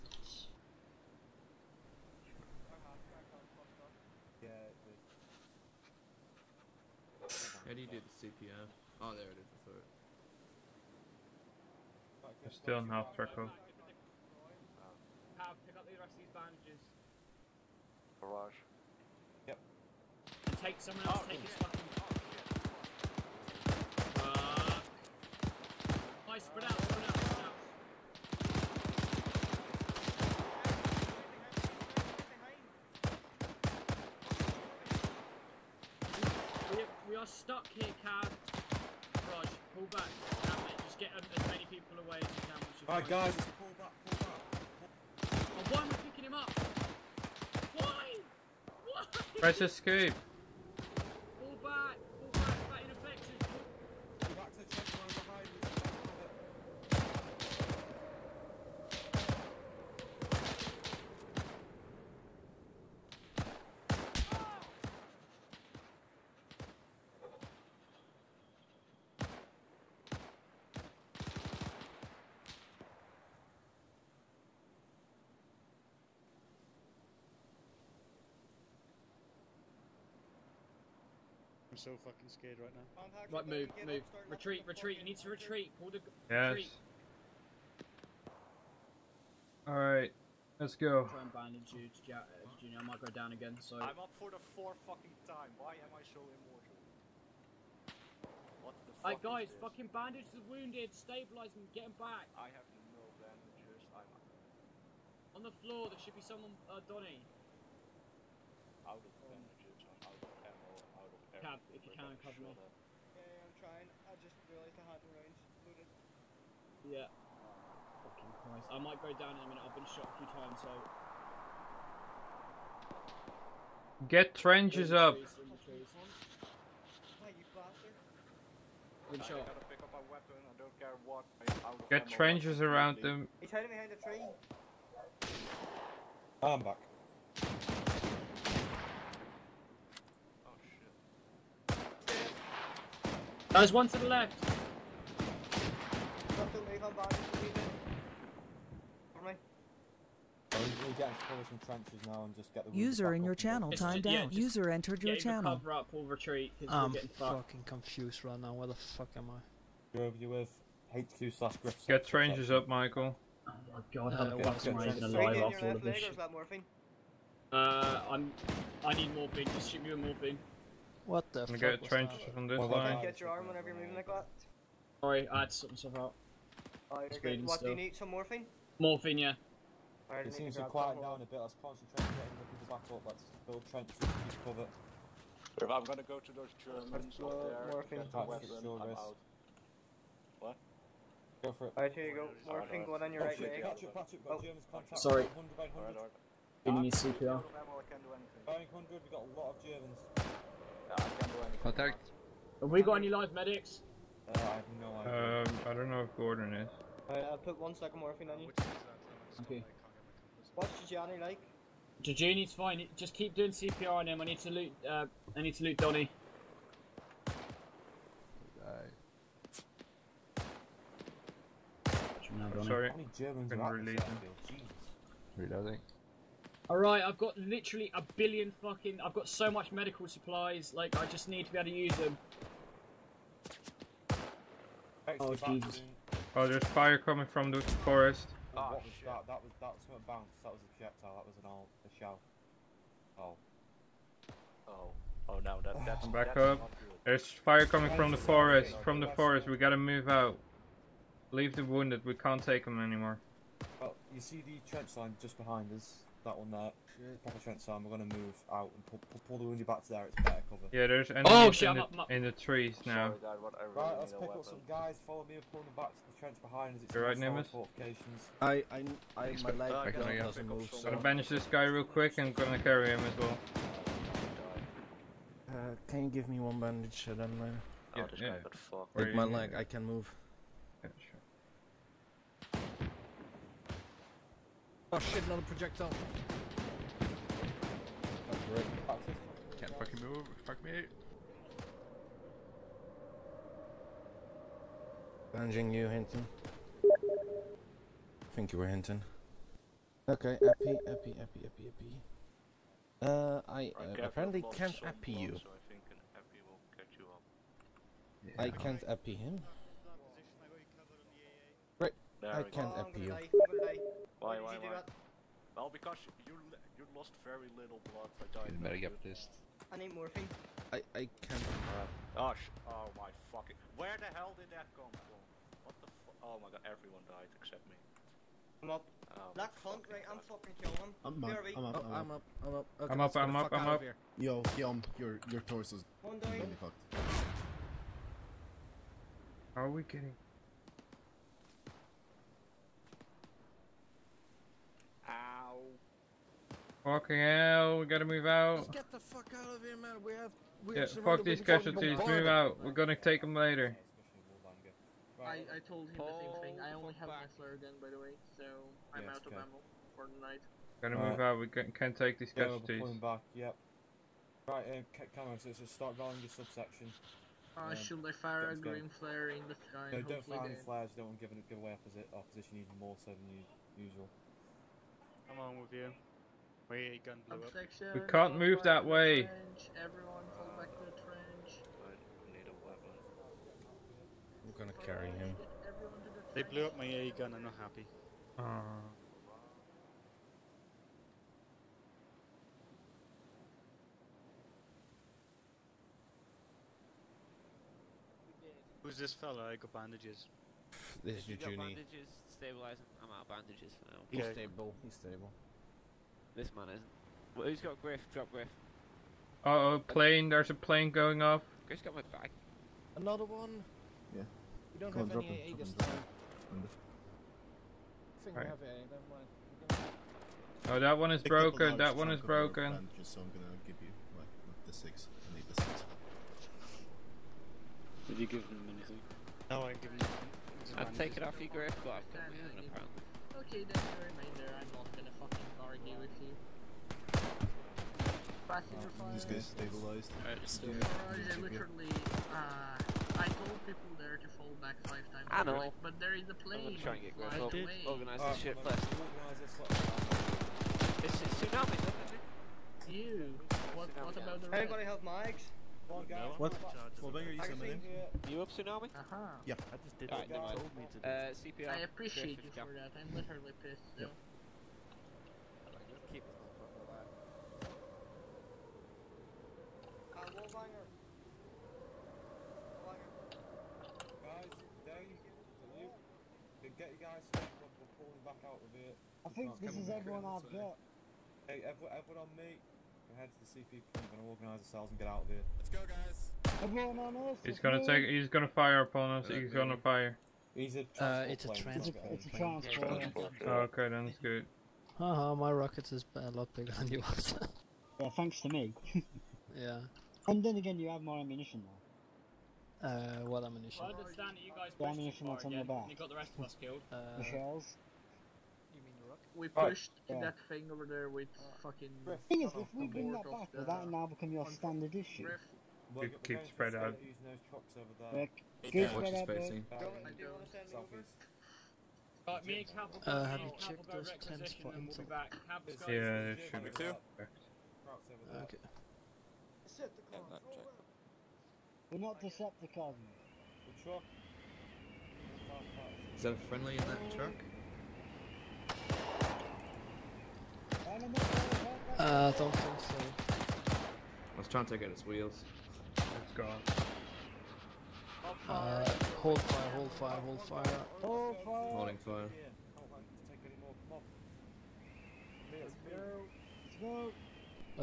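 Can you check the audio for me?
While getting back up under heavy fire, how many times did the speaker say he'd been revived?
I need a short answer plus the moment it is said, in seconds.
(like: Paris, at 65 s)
fourth, at 94 s.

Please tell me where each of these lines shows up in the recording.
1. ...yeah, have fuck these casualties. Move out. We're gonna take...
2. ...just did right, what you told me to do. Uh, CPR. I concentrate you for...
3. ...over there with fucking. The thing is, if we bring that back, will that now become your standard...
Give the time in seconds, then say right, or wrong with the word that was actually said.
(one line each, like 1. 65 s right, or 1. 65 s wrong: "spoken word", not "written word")
1. 350 s right
2. 459 s wrong: "appreciate", not "concentrate"
3. 510 s right.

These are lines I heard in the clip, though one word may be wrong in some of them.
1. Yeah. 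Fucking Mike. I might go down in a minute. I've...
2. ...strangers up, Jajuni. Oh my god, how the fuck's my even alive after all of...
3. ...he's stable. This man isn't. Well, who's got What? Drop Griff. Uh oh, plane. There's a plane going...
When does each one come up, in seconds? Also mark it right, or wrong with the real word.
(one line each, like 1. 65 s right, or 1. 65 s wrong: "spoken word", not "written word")
1. 116 s wrong: "Christ", not "Mike"
2. 162 s wrong: "Michael", not "Jajuni"
3. 404 s wrong: "Griff", not "What".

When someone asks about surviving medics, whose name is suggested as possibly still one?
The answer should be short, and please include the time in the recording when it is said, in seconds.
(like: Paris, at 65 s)
Gordon, at 206 s.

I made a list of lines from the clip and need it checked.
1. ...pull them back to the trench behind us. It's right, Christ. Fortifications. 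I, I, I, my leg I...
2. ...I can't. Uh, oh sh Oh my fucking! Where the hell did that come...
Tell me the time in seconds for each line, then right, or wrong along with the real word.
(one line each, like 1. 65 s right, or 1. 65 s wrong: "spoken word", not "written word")
1. 265 s wrong: "Nimbus", not "Christ"
2. 320 s right.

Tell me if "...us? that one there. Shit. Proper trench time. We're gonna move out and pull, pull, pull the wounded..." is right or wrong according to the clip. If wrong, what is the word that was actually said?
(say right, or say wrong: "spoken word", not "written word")
right.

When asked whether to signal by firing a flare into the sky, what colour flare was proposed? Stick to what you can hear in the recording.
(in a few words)
green.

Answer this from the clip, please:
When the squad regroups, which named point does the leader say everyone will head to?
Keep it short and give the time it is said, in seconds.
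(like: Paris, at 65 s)
CP point, at 483 s.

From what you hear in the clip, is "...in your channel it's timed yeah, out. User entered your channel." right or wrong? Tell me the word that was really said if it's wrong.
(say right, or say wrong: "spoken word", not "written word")
right.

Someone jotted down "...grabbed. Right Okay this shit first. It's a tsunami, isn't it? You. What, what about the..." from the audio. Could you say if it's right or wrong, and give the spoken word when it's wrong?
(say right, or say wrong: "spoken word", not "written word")
wrong: "Organize", not "Okay".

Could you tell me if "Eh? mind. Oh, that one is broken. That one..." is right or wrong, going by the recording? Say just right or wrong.
right.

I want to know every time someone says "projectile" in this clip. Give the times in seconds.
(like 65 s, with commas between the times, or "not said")
240 s, 285 s.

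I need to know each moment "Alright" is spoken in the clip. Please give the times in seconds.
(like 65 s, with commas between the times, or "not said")
42 s, 89 s, 191 s, 207 s, 226 s, 440 s.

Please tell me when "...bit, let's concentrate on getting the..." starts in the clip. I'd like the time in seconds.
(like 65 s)
181 s.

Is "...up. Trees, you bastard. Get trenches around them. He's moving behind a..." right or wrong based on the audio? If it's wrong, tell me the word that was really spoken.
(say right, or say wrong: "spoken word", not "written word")
wrong: "hiding", not "moving".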